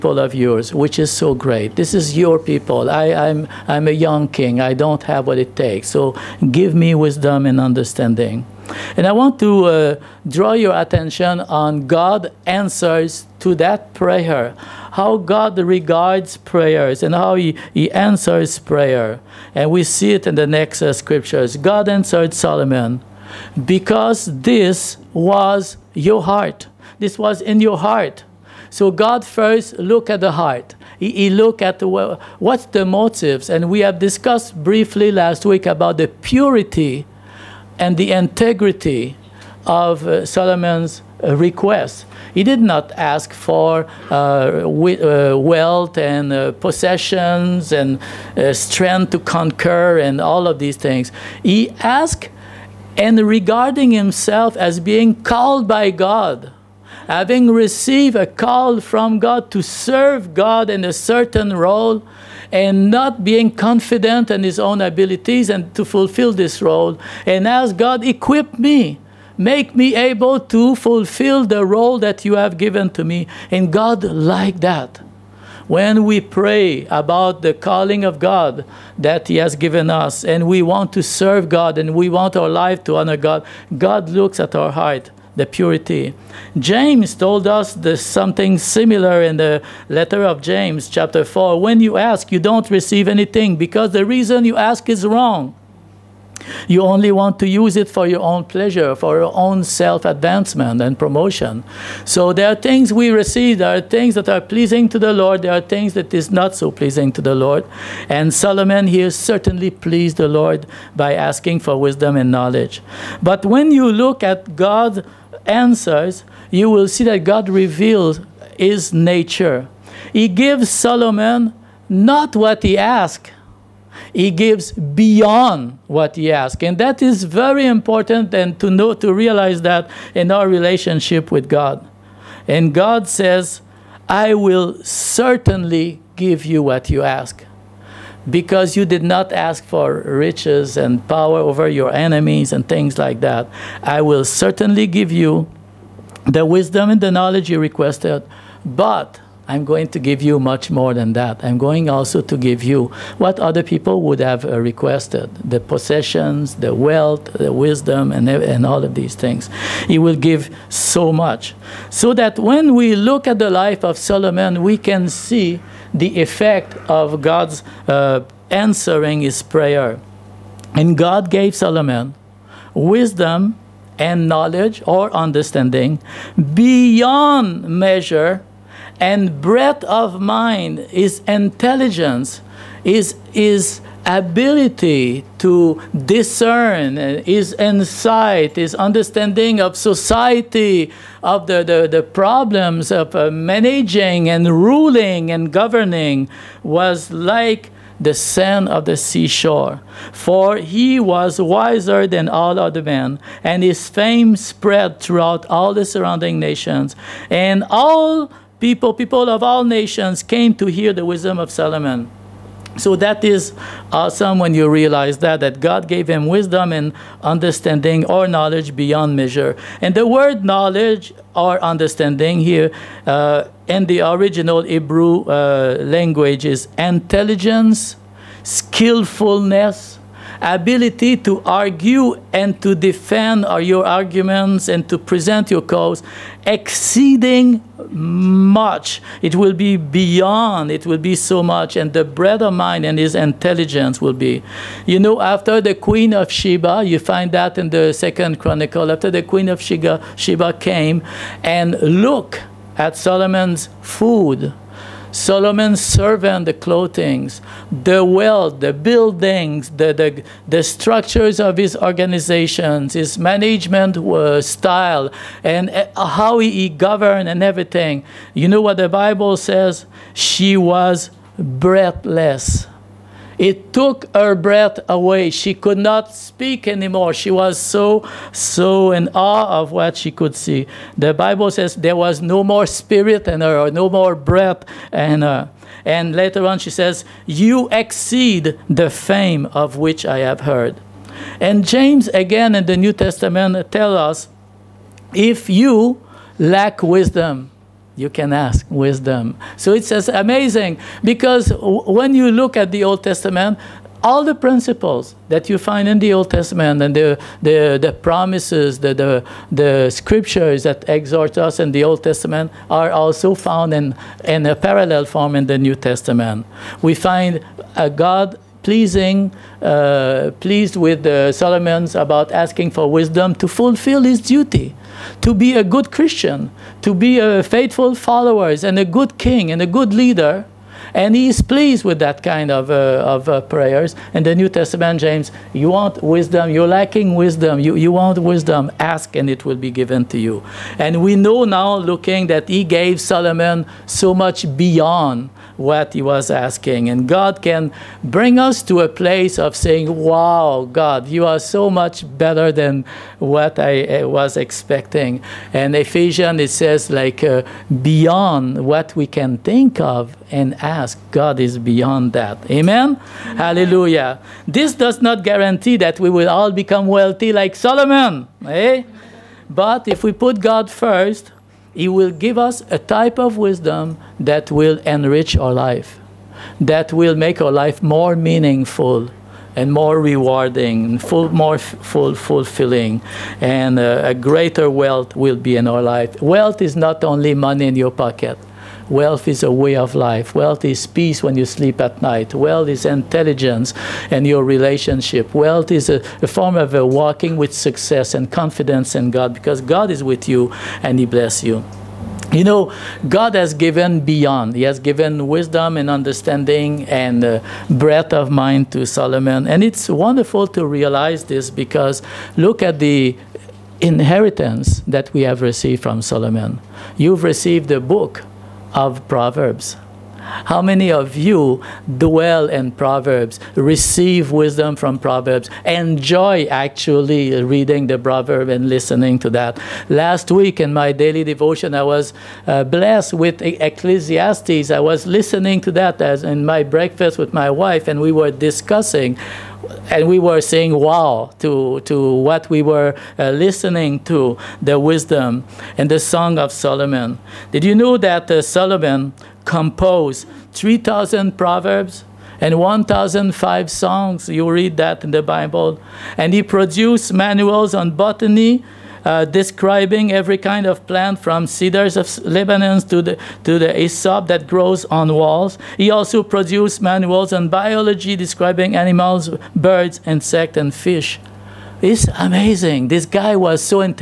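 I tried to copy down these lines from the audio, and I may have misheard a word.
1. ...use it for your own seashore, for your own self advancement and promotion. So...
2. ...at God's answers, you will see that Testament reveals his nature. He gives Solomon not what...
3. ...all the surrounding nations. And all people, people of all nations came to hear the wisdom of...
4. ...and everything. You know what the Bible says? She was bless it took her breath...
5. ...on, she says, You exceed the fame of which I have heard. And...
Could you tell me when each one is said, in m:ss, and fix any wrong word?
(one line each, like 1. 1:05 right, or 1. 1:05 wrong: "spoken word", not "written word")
1. 1:37 wrong: "pleasure", not "seashore"
2. 1:54 wrong: "God", not "Testament"
3. 3:25 right
4. 4:27 wrong: "breathless", not "bless"
5. 4:46 right.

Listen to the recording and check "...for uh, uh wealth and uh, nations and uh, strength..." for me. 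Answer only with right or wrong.
wrong.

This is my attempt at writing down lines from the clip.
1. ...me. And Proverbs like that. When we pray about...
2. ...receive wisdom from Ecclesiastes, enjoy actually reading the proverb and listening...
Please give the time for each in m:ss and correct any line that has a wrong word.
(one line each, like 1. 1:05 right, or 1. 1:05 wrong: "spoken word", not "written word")
1. 1:13 wrong: "God", not "Proverbs"
2. 7:03 wrong: "Proverbs", not "Ecclesiastes".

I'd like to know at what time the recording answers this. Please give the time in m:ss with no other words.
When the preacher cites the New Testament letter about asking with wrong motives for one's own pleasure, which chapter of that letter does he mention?
1:30.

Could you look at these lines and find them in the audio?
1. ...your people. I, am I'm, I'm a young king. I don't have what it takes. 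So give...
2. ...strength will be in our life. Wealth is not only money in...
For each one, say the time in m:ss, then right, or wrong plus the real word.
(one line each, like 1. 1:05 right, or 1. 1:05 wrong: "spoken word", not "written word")
1. 0:02 right
2. 6:24 wrong: "wealth", not "strength".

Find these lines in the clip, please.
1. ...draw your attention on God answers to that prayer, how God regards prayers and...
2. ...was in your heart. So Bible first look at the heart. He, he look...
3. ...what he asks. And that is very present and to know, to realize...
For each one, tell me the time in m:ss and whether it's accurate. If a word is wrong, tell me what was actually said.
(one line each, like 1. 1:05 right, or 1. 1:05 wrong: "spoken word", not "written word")
1. 0:10 right
2. 0:27 wrong: "God", not "Bible"
3. 2:05 wrong: "important", not "present".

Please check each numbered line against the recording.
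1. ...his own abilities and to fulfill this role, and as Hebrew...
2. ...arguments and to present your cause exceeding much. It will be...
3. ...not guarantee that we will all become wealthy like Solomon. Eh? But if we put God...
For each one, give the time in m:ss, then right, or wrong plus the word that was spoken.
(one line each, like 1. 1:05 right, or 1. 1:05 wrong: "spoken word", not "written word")
1. 1:04 wrong: "God", not "Hebrew"
2. 3:53 right
3. 6:05 right.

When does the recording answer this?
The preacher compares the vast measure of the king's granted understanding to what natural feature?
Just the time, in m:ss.
3:18.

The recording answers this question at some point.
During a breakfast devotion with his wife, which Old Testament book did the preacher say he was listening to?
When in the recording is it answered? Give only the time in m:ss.
7:13.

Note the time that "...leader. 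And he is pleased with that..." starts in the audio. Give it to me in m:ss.
5:29.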